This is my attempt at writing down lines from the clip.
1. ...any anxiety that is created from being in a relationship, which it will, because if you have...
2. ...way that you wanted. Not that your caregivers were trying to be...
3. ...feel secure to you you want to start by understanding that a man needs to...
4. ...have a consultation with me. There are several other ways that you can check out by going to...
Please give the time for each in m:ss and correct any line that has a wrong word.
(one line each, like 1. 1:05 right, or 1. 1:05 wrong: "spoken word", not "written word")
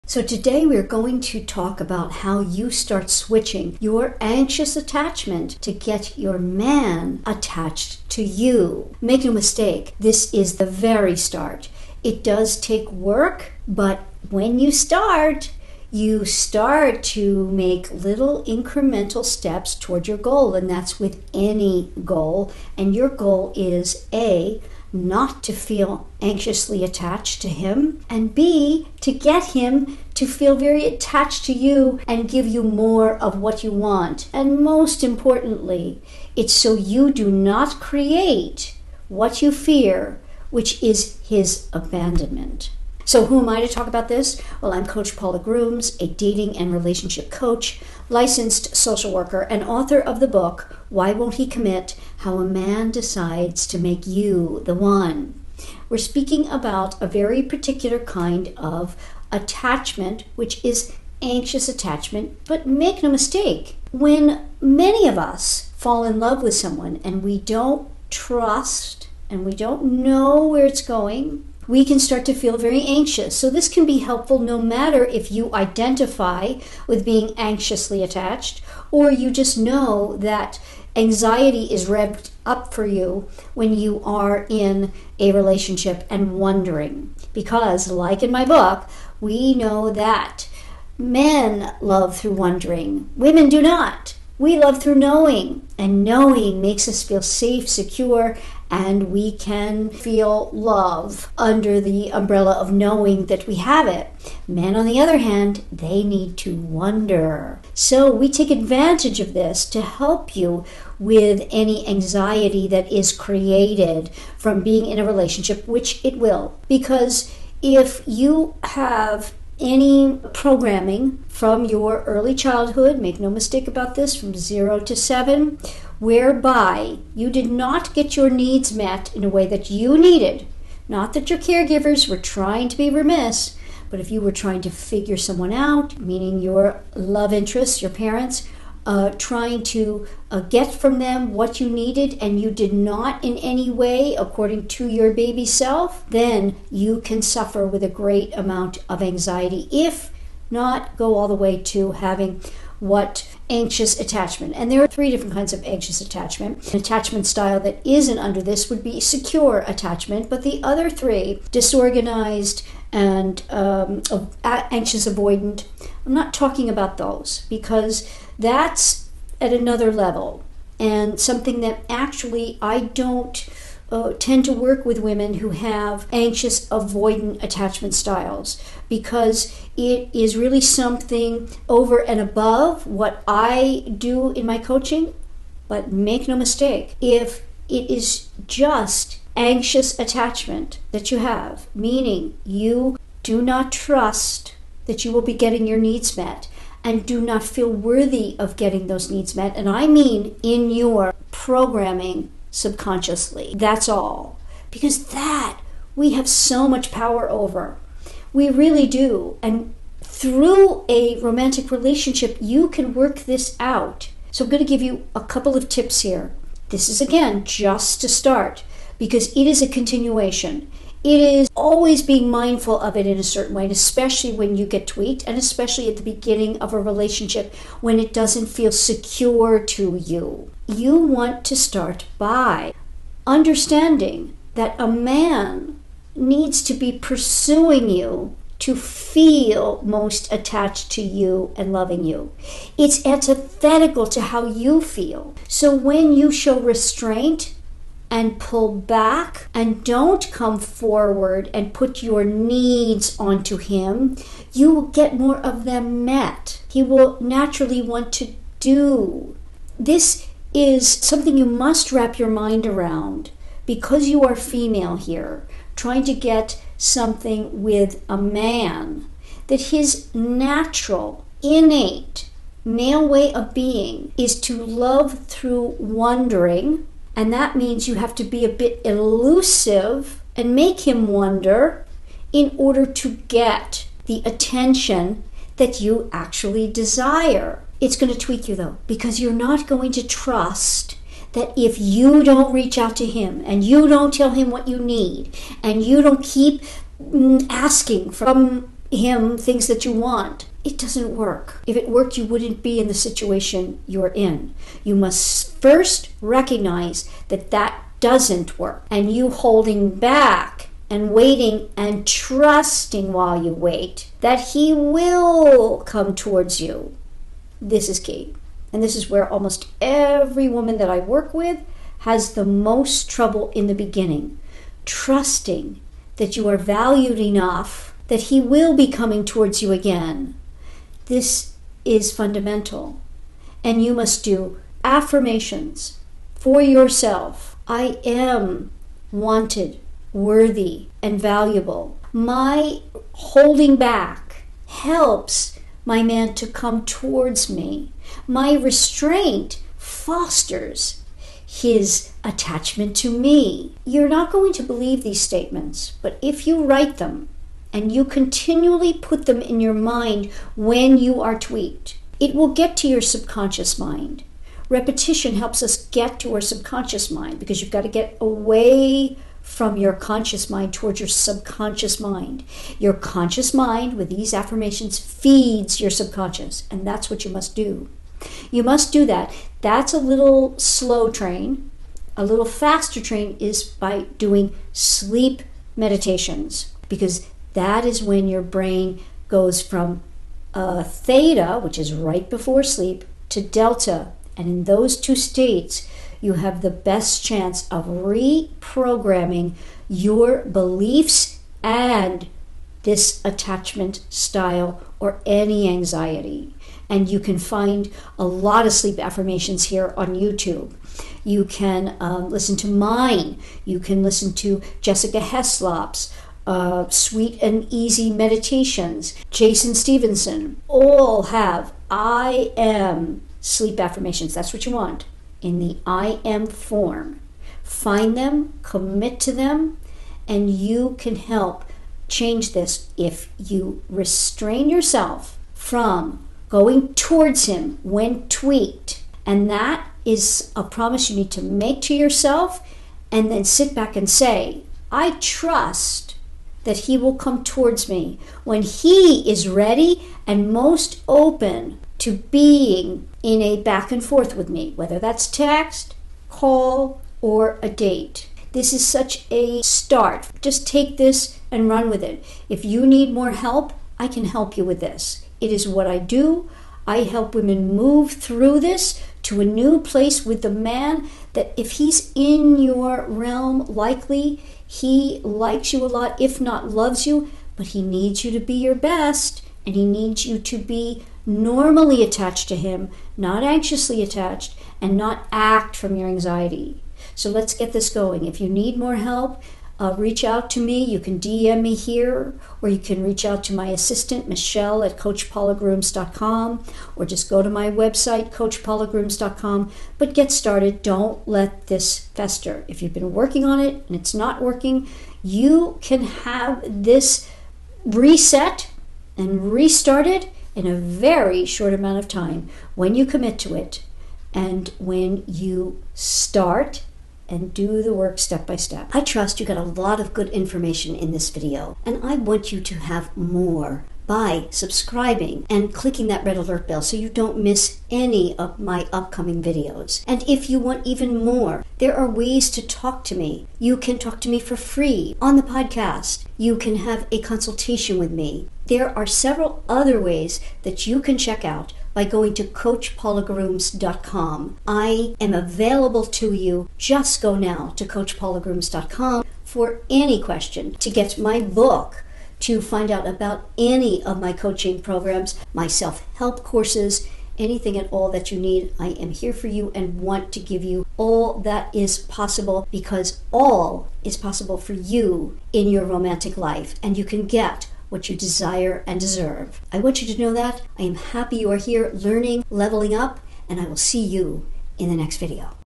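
1. 1:51 right
2. 2:09 wrong: "needed", not "wanted"
3. 3:48 right
4. 8:56 right.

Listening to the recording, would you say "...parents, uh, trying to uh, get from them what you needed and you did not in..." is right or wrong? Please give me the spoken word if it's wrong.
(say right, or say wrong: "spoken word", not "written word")
right.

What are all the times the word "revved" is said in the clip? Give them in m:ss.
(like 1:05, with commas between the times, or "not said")
1:21.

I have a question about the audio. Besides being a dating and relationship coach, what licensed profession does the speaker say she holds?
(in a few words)
social worker.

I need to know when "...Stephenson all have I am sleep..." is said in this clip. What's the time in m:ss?
6:59.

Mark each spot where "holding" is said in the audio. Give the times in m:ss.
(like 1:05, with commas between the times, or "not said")
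5:09, 5:43.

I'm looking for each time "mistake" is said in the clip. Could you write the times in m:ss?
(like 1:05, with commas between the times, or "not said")
0:09, 1:03, 2:03, 3:06.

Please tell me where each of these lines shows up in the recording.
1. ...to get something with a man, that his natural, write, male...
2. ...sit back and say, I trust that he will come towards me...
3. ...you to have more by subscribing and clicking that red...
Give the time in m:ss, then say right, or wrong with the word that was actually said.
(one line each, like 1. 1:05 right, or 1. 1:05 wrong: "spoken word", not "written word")
1. 4:26 wrong: "innate", not "write"
2. 7:23 right
3. 8:42 right.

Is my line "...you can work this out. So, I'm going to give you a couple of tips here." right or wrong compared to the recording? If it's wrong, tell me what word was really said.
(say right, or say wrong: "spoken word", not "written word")
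right.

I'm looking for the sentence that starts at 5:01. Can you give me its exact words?
If it worked, you wouldn't be in the situation you're in.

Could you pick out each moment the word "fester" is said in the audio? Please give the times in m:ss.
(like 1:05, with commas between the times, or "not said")
8:22.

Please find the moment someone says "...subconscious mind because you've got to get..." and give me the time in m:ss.
6:06.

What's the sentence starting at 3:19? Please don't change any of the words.
And I mean in your programming subconsciously.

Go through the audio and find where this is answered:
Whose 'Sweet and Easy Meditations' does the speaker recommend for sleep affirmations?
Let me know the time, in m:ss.
6:54.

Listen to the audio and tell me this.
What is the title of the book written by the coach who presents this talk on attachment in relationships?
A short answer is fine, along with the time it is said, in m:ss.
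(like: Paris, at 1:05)
Why Won't He Commit?, at 0:50.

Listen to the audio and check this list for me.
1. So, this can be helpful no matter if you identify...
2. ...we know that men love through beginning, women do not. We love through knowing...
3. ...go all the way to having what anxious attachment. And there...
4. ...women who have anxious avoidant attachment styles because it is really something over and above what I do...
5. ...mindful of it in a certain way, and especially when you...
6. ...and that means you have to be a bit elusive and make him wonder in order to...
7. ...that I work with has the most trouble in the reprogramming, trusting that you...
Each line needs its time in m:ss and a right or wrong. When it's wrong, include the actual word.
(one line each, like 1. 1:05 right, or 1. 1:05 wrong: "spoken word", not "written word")
1. 1:13 right
2. 1:29 wrong: "wondering", not "beginning"
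3. 2:30 right
4. 2:55 right
5. 3:42 right
6. 4:37 right
7. 5:20 wrong: "beginning", not "reprogramming".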